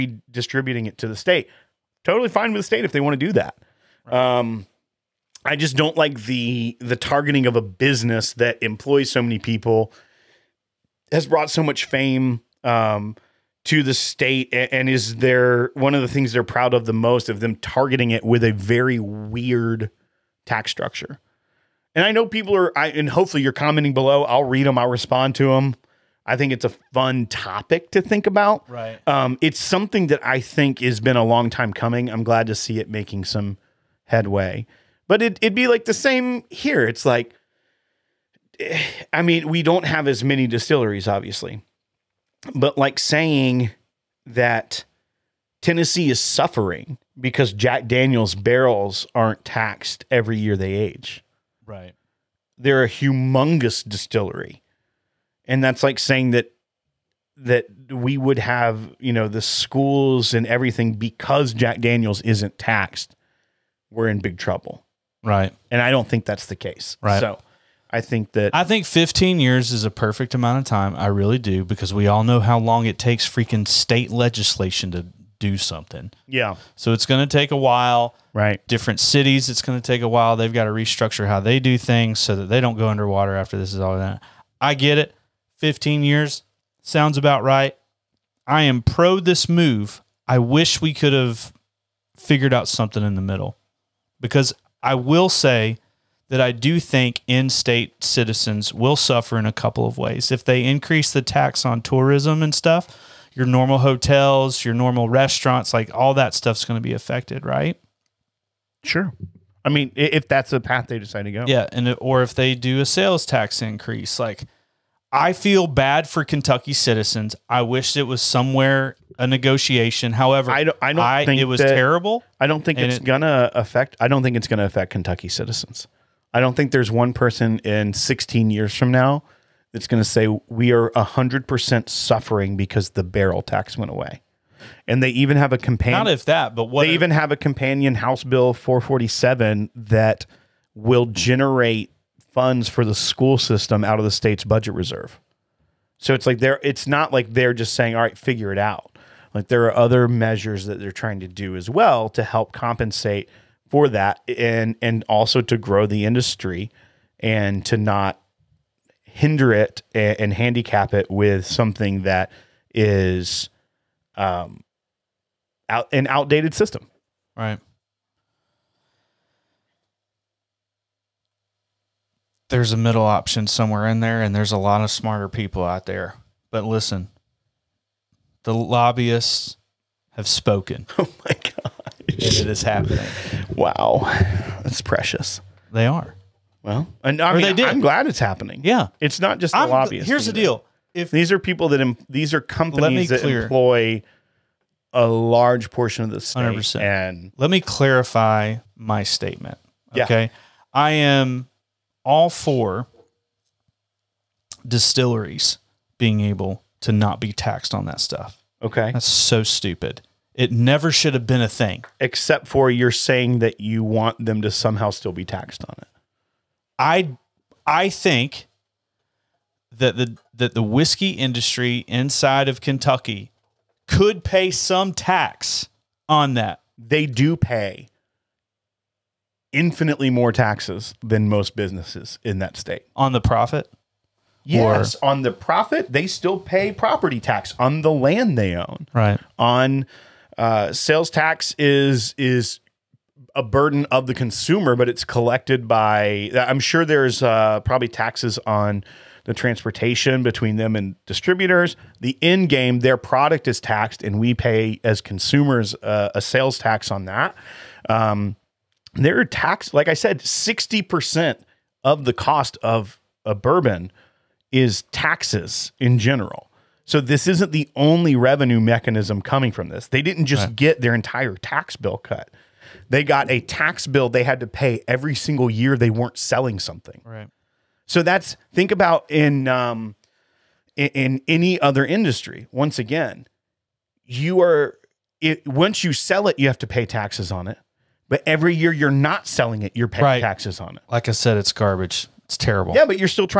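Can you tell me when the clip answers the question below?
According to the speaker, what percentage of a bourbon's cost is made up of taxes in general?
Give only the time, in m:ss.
4:20.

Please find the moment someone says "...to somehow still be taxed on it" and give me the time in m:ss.
3:34.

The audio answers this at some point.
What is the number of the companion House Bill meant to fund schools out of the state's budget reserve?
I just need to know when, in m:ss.
2:18.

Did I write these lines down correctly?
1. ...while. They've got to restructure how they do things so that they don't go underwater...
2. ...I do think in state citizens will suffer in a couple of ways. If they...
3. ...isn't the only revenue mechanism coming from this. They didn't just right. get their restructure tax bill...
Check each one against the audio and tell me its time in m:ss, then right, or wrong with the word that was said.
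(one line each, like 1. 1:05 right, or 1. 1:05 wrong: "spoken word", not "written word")
1. 1:20 right
2. 1:36 right
3. 4:27 wrong: "entire", not "restructure".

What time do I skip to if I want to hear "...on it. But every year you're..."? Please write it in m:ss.
4:47.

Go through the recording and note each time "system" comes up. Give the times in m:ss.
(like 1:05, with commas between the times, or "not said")
2:23, 2:46.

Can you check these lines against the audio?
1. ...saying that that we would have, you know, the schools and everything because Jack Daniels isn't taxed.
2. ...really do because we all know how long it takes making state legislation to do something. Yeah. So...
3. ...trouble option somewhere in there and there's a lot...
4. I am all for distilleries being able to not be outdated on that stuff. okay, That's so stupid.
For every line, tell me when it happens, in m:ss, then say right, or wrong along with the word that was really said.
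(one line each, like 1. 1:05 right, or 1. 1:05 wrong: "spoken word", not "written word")
1. 0:55 right
2. 1:11 wrong: "freaking", not "making"
3. 2:52 wrong: "middle", not "trouble"
4. 3:20 wrong: "taxed", not "outdated".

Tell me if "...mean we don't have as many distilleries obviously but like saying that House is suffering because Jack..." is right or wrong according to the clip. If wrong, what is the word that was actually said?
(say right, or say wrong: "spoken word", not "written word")
wrong: "Tennessee", not "House".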